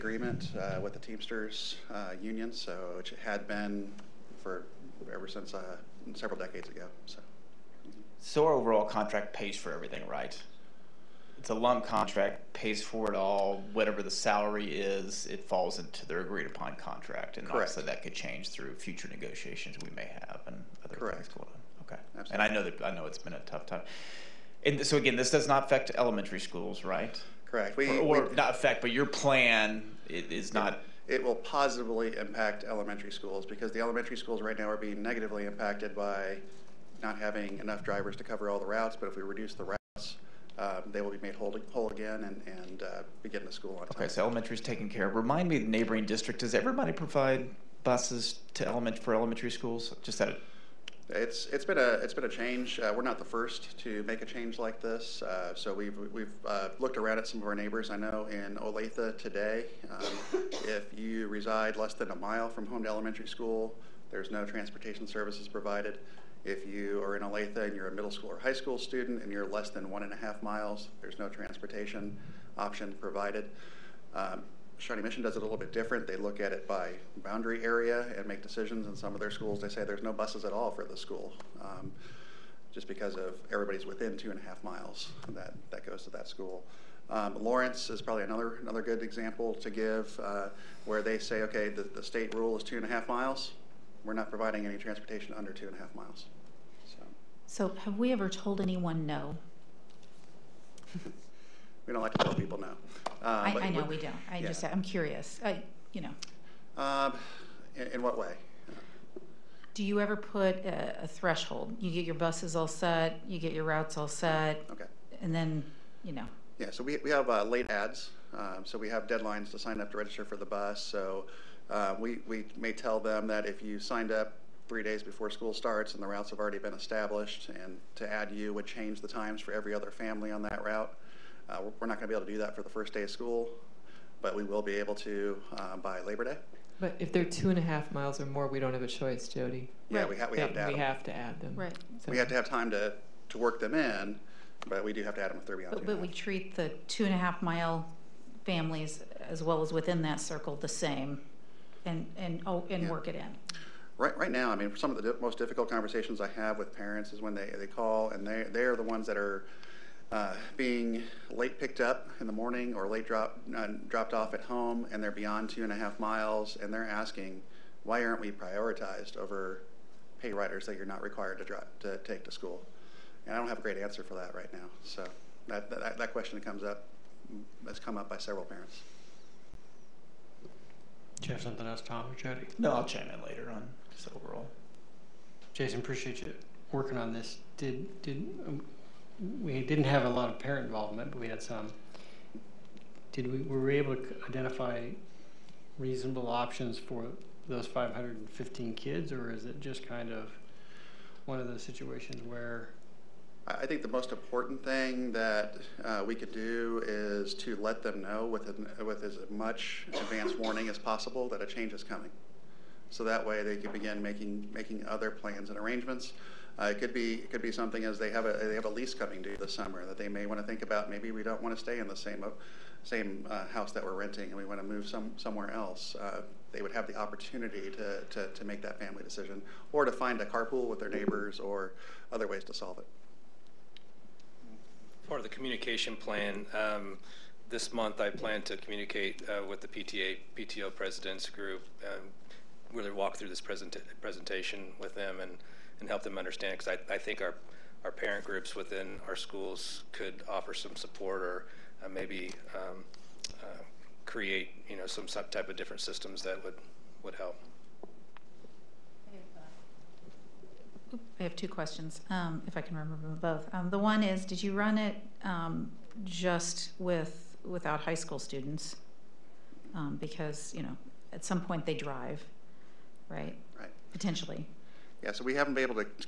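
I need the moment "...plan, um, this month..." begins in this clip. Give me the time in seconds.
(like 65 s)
235 s.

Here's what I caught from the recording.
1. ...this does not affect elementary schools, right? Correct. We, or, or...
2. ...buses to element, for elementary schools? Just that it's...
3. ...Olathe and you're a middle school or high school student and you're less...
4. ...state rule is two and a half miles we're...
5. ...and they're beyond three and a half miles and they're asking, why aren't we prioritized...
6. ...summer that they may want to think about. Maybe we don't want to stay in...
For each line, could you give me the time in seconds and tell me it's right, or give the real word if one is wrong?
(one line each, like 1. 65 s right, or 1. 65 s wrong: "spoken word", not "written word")
1. 25 s right
2. 47 s right
3. 67 s right
4. 92 s right
5. 164 s wrong: "two", not "three"
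6. 219 s right.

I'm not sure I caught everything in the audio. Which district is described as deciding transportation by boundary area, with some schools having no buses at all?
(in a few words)
Shawnee Mission.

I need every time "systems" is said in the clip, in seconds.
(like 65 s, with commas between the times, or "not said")
255 s.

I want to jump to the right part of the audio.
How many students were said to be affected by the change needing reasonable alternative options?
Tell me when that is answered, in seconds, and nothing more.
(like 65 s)
197 s.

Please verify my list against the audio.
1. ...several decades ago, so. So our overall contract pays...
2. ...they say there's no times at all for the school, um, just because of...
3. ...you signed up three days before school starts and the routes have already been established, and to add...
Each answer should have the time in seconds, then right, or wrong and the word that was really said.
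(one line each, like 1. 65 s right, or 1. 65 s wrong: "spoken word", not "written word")
1. 6 s right
2. 79 s wrong: "buses", not "times"
3. 123 s right.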